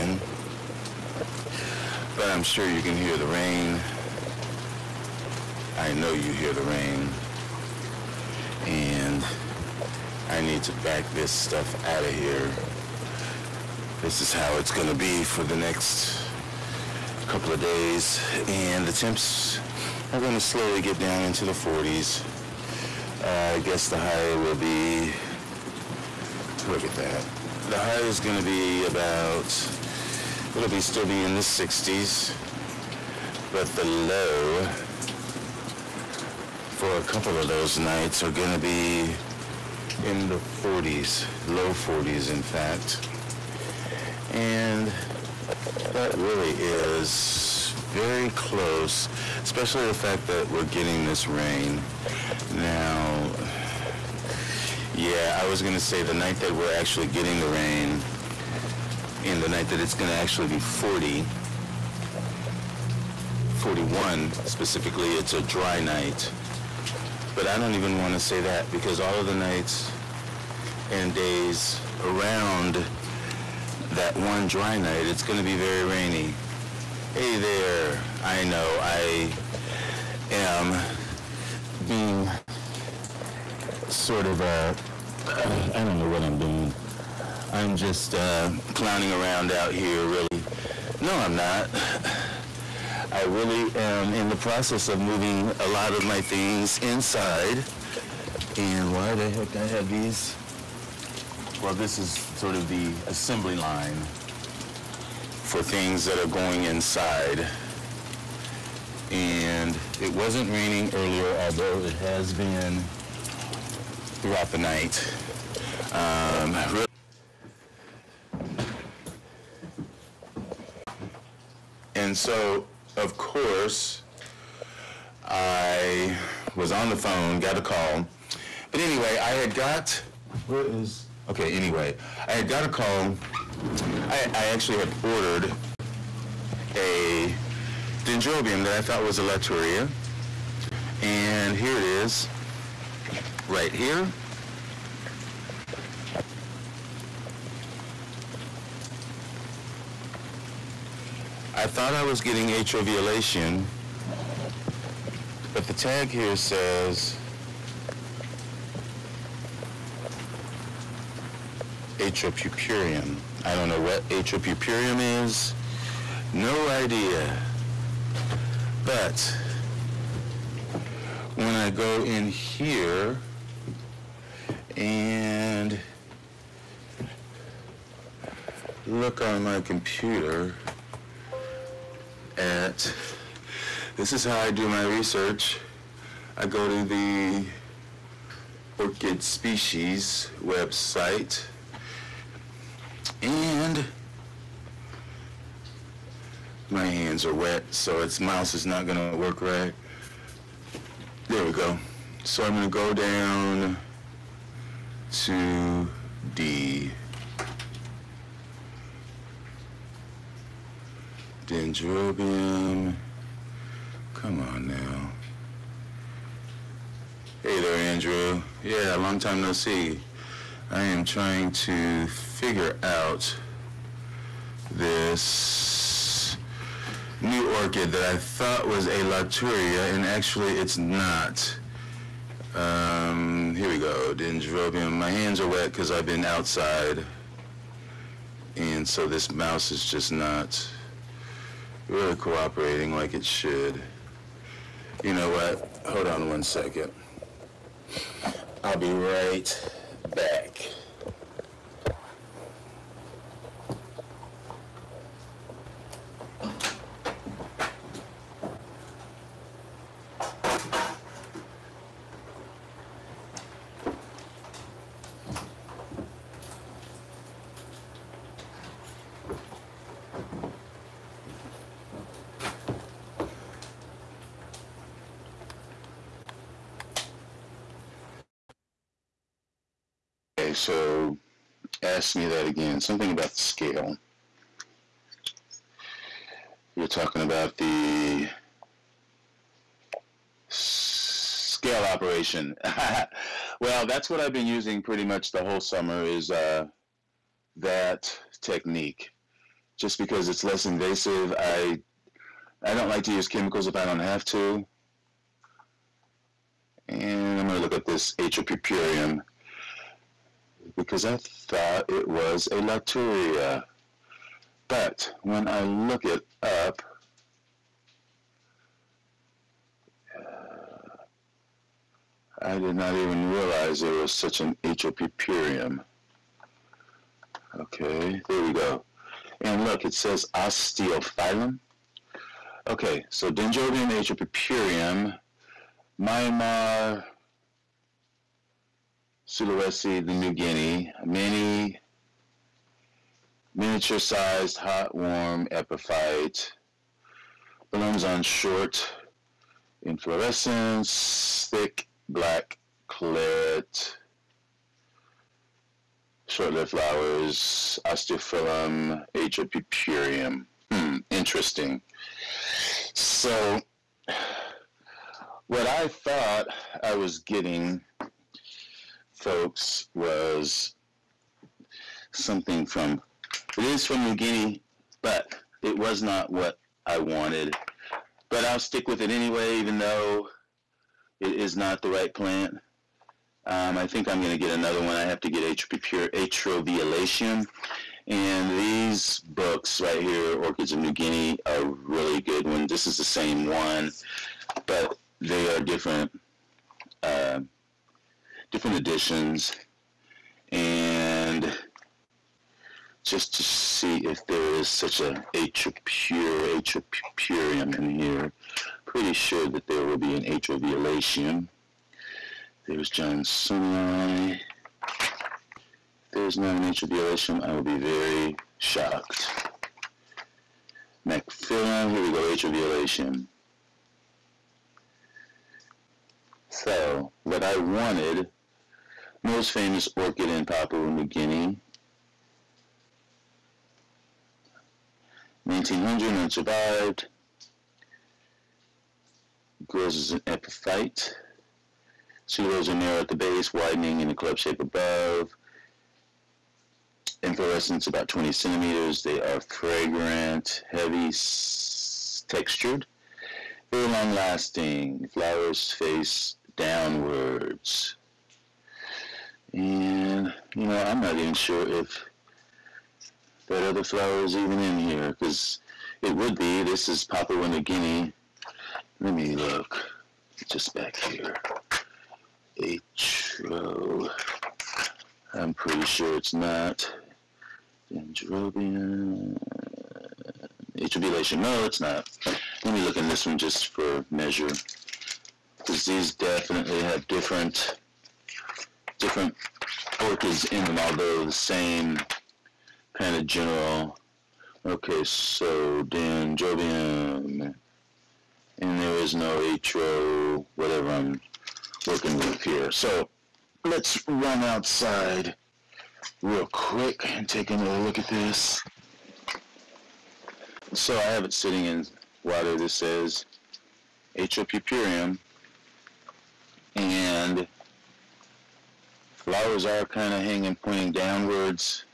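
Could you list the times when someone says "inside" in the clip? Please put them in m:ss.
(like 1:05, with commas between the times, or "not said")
1:36, 1:46.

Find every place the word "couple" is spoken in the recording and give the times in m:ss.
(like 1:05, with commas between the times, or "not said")
0:17, 0:37.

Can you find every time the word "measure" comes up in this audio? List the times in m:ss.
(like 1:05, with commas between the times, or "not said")
8:04.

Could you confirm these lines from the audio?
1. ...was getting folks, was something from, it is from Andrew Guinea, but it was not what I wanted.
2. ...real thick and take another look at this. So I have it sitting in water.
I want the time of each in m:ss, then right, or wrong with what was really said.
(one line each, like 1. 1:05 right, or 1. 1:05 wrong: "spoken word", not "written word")
1. 6:06 wrong: "New", not "Andrew"
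2. 8:26 wrong: "quick", not "thick".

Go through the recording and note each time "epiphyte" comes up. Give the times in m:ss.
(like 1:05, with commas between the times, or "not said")
5:45, 7:20.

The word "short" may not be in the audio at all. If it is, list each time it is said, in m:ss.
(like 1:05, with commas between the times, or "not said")
5:48, 5:56.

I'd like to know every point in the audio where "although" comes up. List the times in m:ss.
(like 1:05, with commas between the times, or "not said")
1:51, 8:10.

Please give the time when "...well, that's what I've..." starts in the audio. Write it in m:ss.
4:53.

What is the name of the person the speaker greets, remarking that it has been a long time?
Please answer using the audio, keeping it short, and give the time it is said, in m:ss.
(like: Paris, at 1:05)
Andrew, at 3:37.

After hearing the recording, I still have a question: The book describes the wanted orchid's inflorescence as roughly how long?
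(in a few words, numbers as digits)
20 centimeters.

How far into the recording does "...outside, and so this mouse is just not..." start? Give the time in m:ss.
3:56.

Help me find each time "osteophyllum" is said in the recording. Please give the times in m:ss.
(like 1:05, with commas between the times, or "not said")
5:30, 5:57.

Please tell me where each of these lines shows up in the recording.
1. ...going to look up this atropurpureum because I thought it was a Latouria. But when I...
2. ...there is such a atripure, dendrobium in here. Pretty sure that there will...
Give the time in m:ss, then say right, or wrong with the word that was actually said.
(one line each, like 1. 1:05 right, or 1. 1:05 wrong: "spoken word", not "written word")
1. 5:07 right
2. 6:44 wrong: "atripurium", not "dendrobium".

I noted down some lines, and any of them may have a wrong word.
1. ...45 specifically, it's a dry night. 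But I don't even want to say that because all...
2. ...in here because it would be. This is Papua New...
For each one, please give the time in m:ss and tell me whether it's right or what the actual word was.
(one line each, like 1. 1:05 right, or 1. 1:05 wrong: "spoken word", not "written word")
1. 1:03 wrong: "41", not "45"
2. 7:44 right.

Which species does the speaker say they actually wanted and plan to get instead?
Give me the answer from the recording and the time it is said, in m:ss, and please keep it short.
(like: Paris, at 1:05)
atroviolaceum, at 6:25.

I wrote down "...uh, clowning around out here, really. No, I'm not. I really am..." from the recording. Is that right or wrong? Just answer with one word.
right.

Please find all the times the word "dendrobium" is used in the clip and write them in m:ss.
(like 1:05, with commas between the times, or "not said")
2:18, 3:31, 3:54, 5:33, 7:57.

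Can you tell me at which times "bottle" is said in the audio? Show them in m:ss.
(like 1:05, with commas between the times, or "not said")
not said.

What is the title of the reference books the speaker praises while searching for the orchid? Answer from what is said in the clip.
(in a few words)
Orchids of New Guinea.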